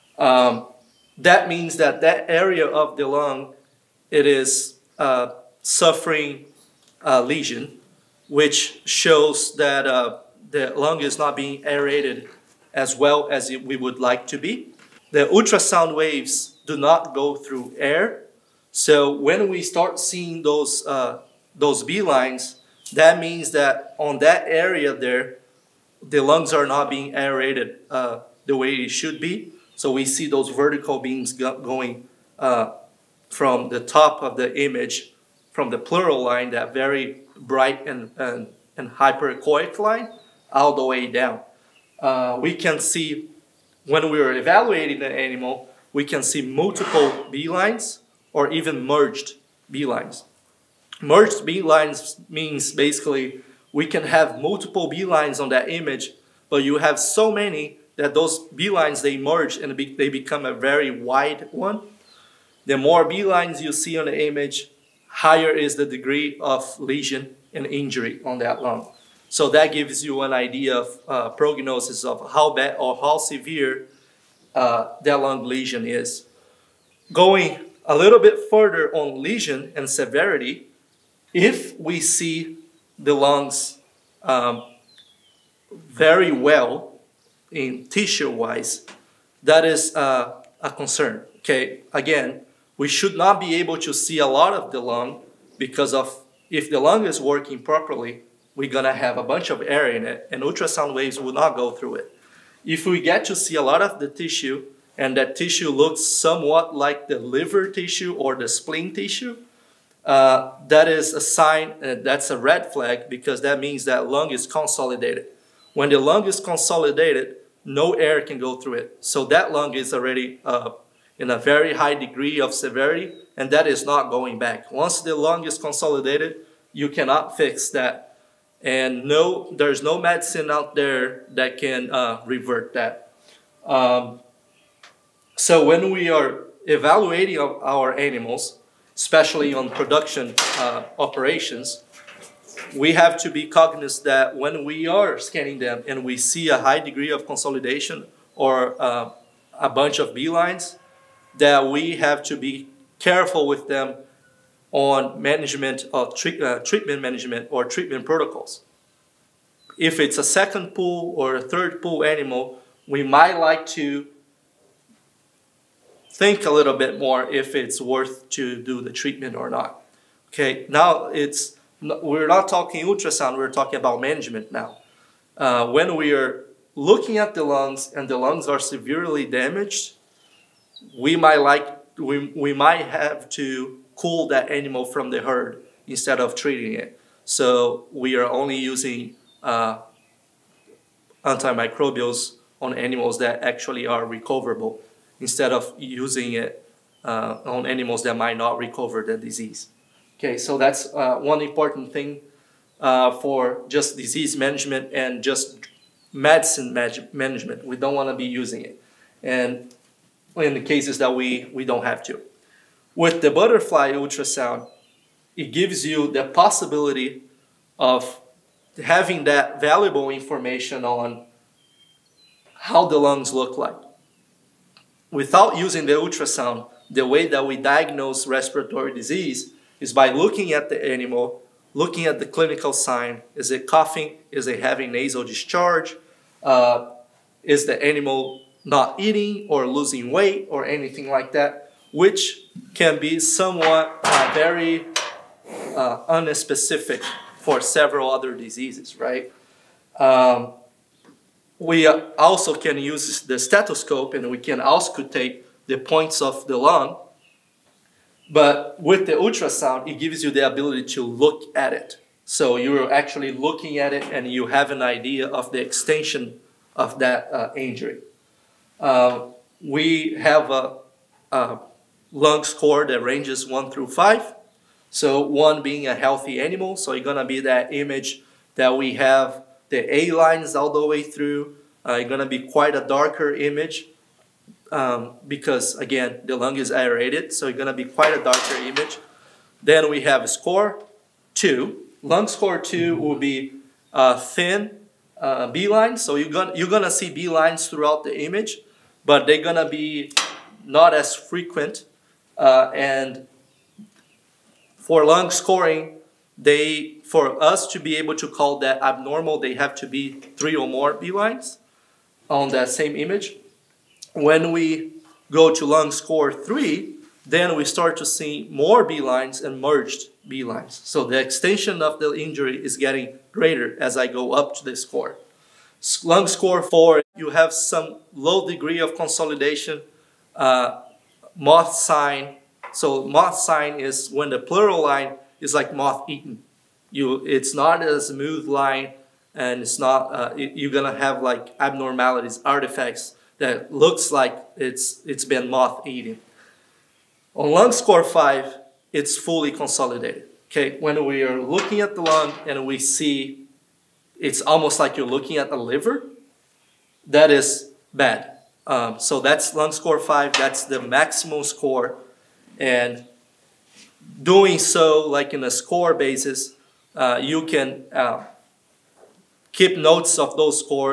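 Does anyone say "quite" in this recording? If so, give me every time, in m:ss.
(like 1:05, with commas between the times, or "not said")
4:42, 4:47.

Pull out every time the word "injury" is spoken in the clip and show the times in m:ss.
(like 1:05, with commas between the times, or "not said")
1:07, 4:27, 5:22.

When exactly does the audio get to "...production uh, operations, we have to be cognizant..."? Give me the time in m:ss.
2:19.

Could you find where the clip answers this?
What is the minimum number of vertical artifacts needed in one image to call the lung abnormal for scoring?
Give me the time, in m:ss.
5:10.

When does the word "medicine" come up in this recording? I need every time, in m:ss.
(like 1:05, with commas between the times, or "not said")
2:09, 3:26.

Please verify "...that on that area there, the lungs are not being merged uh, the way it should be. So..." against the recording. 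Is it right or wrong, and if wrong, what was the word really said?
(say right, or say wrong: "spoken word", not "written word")
wrong: "aerated", not "merged".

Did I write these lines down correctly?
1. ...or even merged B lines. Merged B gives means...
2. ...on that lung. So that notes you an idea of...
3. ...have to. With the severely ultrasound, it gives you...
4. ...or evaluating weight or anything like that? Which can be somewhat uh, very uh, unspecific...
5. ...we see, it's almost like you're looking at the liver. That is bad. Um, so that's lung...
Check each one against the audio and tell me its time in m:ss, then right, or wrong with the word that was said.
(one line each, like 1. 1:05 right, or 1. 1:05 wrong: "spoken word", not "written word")
1. 0:48 wrong: "lines", not "gives"
2. 1:08 wrong: "gives", not "notes"
3. 3:31 wrong: "butterfly", not "severely"
4. 3:59 wrong: "losing", not "evaluating"
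5. 5:52 right.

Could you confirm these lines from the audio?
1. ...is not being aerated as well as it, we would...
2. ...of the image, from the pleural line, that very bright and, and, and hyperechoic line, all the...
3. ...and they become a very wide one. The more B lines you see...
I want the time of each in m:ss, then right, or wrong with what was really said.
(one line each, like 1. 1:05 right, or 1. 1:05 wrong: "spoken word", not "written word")
1. 0:11 right
2. 0:34 right
3. 0:59 right.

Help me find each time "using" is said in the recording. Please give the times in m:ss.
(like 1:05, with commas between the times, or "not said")
3:08, 3:15, 3:28, 3:45.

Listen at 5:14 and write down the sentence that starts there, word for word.
When we go to lung score three, then we start to see more B lines and merged B lines.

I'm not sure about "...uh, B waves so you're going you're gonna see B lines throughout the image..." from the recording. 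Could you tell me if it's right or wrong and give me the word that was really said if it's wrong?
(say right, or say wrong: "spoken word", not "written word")
wrong: "lines", not "waves".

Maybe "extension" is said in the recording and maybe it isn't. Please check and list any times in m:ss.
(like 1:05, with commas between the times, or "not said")
4:25, 5:21.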